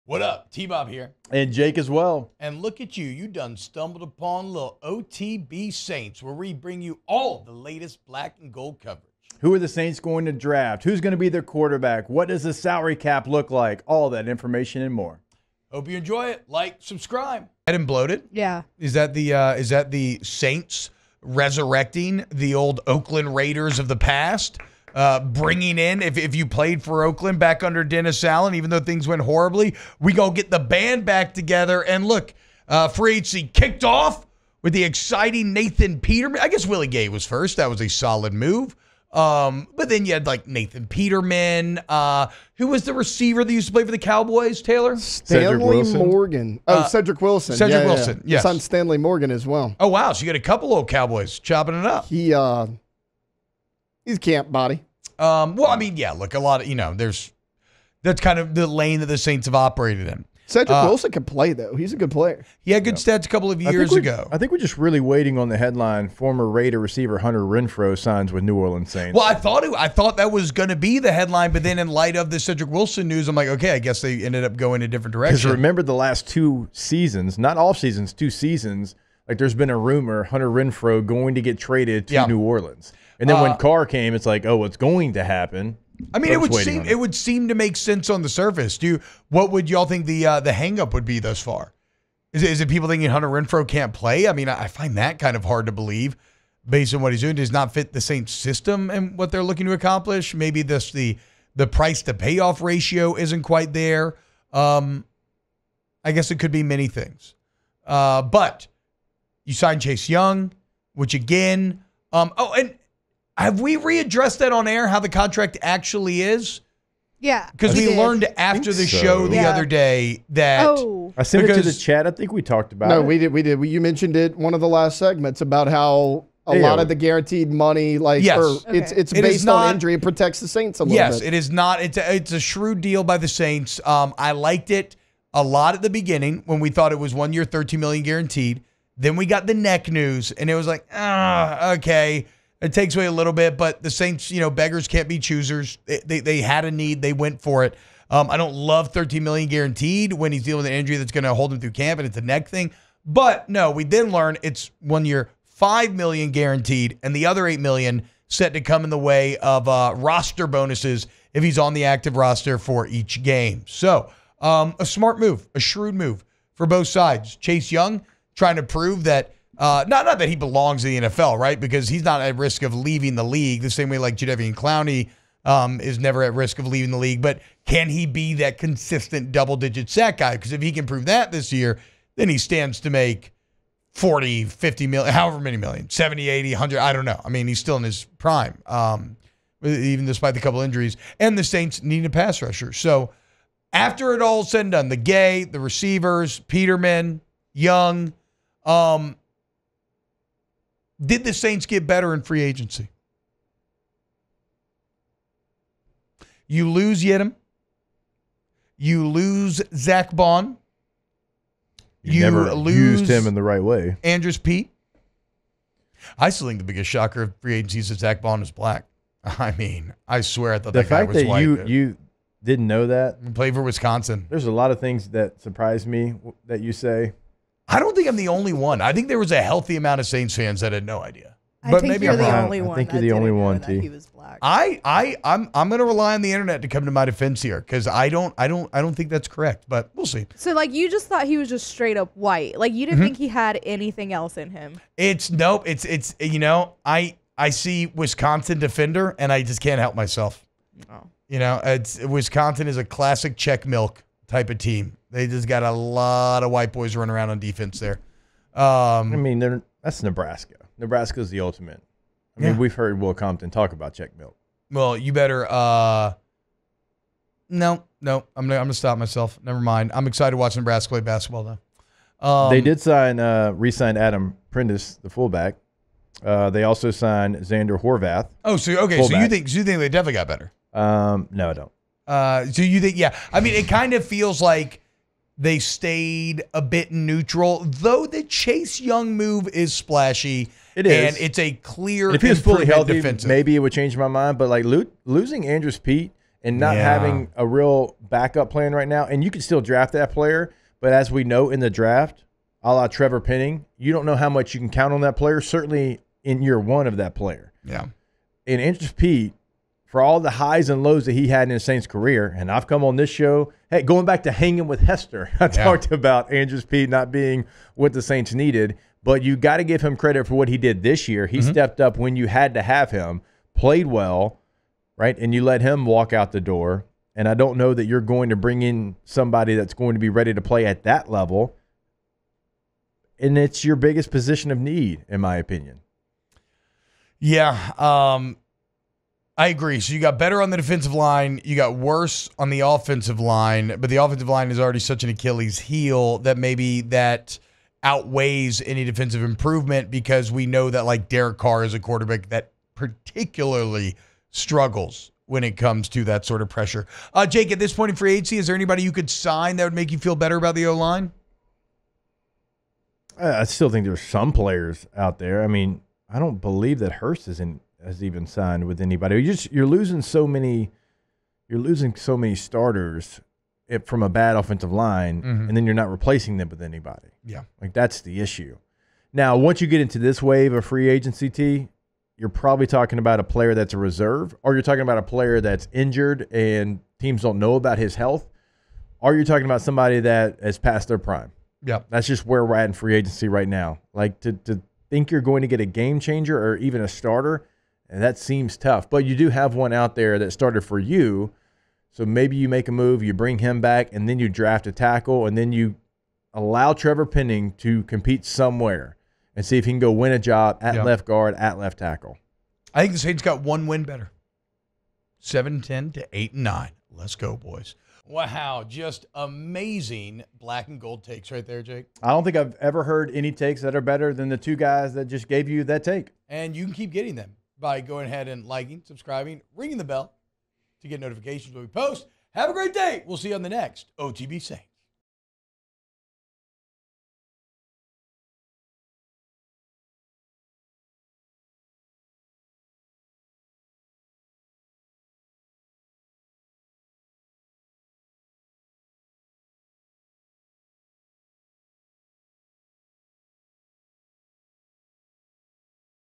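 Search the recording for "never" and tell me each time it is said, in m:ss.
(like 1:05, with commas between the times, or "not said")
2:55, 3:32, 4:29.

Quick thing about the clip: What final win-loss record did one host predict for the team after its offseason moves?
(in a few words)
8-9.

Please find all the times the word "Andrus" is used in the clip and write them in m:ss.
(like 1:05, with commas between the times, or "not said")
3:34, 4:55, 5:08, 5:16.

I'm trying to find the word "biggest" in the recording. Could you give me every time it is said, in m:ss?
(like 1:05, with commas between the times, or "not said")
3:36, 5:33.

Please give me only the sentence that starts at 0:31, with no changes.
And look, uh, free agency kicked off with the exciting Nathan Peterman.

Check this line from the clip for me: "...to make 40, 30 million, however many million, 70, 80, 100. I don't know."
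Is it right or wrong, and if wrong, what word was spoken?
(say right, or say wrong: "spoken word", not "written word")
wrong: "50", not "30".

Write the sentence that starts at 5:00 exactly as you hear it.
But as we know in the draft, a la Trevor Penning, you don't know how much you can count on that player.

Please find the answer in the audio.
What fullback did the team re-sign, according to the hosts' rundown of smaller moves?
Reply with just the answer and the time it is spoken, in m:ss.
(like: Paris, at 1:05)
Adam Prentice, at 4:33.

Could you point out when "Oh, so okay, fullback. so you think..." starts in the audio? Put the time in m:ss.
4:38.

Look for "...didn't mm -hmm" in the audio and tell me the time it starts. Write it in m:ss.
4:02.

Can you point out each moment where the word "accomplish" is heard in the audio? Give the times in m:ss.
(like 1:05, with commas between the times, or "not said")
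1:39.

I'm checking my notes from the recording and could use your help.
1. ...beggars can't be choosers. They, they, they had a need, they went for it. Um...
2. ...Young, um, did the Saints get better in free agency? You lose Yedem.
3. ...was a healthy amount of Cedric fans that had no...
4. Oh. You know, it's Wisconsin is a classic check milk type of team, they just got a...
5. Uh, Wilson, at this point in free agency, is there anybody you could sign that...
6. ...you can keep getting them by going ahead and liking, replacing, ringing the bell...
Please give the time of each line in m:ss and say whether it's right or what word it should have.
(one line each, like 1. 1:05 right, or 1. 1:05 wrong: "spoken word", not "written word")
1. 2:24 right
2. 3:17 right
3. 3:49 wrong: "Saints", not "Cedric"
4. 4:10 right
5. 5:57 wrong: "Jake", not "Wilson"
6. 7:06 wrong: "subscribing", not "replacing".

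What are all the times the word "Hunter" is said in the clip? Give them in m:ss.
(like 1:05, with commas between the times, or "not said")
1:07, 1:20, 1:33.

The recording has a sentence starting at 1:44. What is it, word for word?
Um, I guess it could be many things.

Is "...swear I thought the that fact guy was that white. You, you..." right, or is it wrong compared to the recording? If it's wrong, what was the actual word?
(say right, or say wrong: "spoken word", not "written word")
right.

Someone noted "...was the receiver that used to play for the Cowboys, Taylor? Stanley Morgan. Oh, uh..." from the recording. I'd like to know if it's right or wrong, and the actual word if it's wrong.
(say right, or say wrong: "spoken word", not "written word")
right.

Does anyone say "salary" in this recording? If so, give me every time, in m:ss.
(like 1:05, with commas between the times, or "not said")
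0:12.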